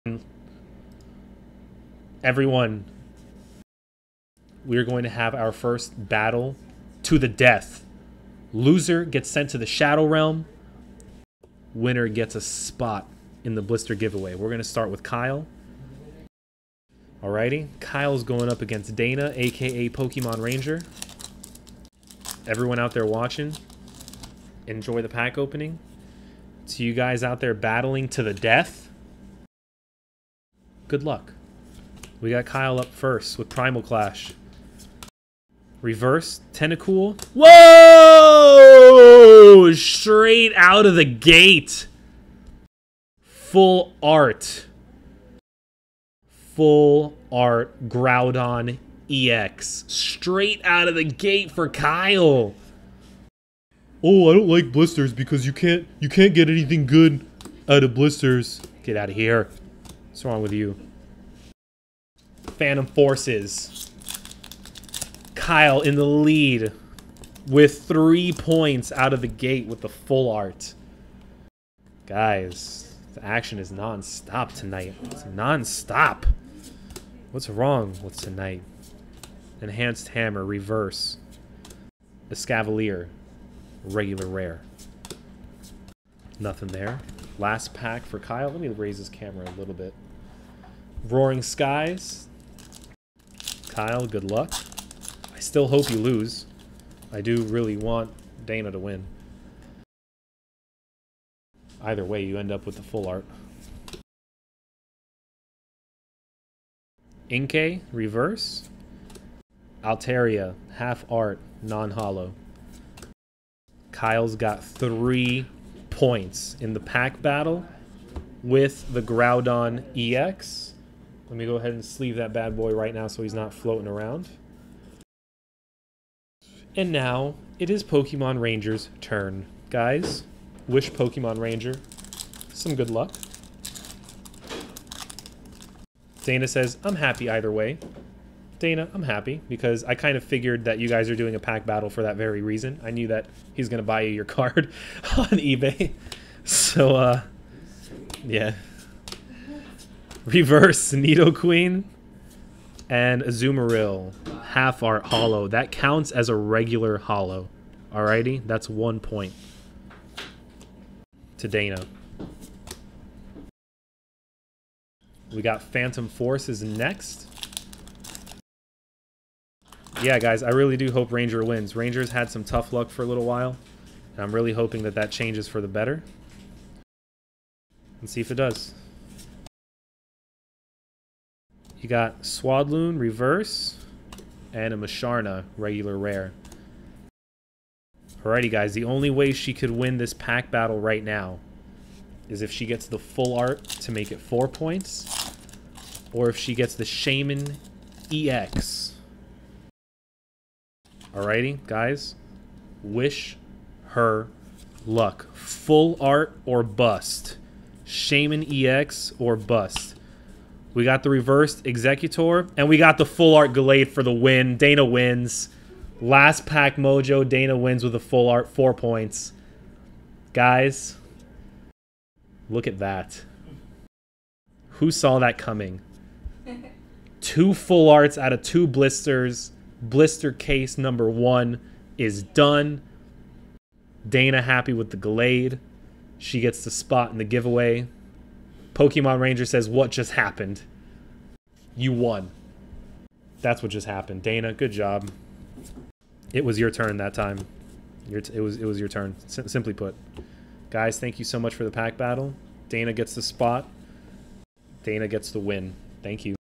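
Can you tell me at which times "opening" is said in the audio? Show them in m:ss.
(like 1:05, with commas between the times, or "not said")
0:25.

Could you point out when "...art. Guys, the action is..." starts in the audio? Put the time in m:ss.
1:10.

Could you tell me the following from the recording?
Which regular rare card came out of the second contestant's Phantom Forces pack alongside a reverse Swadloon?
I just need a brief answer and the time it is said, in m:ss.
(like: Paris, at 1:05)
Musharna, at 3:04.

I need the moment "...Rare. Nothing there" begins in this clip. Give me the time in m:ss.
1:24.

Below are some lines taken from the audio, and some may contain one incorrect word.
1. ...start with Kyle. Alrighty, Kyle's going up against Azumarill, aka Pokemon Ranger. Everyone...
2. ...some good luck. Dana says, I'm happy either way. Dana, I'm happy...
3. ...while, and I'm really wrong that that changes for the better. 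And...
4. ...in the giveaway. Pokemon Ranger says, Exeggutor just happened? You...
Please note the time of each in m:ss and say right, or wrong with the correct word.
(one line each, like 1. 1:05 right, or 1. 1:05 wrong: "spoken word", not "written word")
1. 0:14 wrong: "Dana", not "Azumarill"
2. 2:12 right
3. 2:53 wrong: "hoping", not "wrong"
4. 3:57 wrong: "What", not "Exeggutor".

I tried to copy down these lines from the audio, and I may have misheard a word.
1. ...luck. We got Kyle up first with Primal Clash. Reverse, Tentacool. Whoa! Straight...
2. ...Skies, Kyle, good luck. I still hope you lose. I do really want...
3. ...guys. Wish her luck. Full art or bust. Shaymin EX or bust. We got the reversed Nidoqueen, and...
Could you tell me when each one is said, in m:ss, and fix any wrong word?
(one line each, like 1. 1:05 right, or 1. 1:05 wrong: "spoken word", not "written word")
1. 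0:31 right
2. 1:31 right
3. 3:21 wrong: "Exeggutor", not "Nidoqueen".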